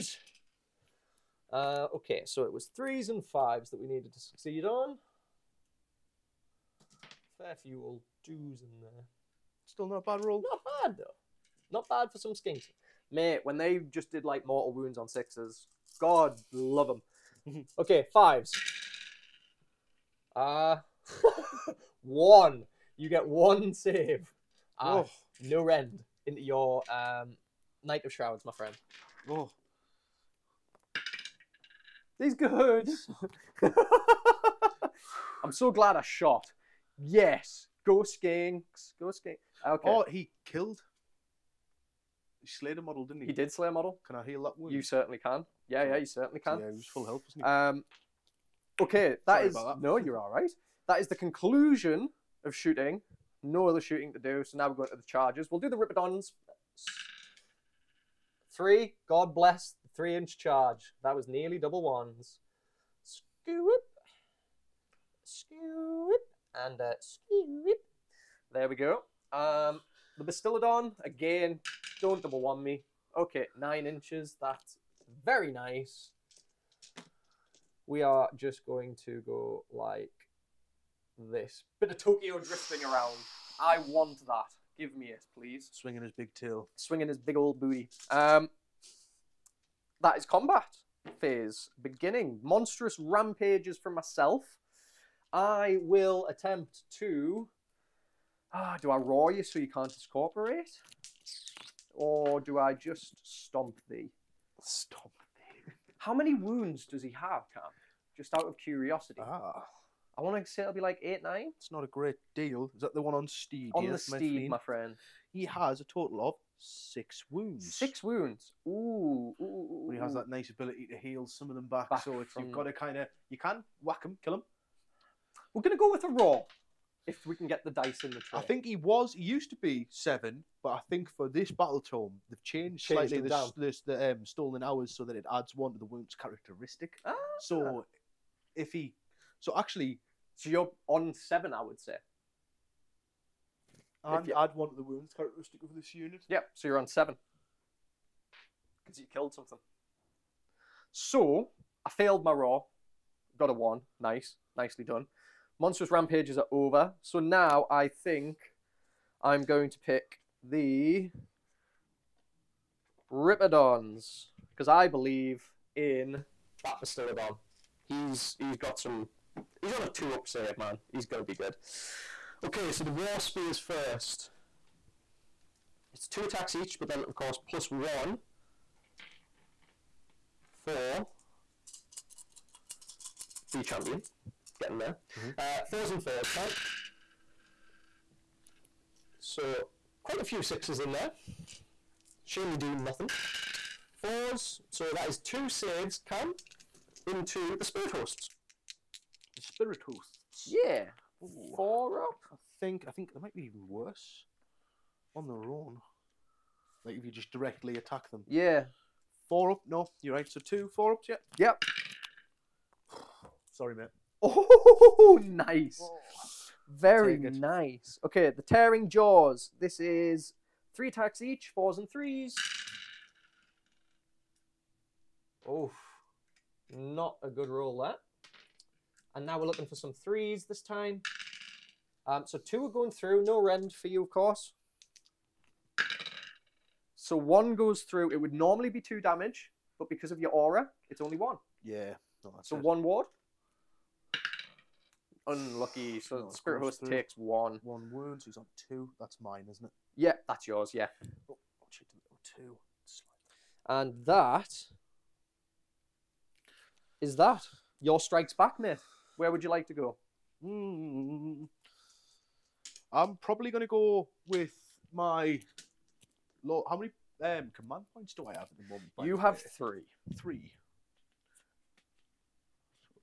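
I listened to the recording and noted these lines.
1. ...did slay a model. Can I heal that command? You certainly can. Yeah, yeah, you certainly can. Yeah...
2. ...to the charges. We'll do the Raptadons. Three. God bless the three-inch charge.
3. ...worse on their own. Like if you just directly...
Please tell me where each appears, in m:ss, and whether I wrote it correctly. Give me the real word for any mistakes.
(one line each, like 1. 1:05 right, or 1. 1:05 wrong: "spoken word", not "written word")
1. 0:43 wrong: "wound", not "command"
2. 0:54 right
3. 3:23 right.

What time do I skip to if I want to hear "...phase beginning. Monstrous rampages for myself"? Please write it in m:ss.
1:31.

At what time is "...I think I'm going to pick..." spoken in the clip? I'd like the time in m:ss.
2:37.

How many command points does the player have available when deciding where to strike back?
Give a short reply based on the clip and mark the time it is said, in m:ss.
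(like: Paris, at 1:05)
3, at 4:29.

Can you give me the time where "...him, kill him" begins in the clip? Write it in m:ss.
2:04.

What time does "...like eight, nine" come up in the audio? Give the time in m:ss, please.
1:50.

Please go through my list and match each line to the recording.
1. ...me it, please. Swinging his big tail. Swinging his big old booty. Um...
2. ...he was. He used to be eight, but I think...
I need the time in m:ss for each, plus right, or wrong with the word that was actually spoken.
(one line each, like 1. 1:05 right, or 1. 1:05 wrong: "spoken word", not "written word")
1. 1:24 right
2. 2:08 wrong: "seven", not "eight".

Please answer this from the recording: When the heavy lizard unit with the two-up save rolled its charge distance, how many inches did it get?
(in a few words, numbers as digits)
9 inches.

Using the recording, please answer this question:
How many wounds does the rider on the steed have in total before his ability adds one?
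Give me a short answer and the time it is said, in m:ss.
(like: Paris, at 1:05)
6, at 1:55.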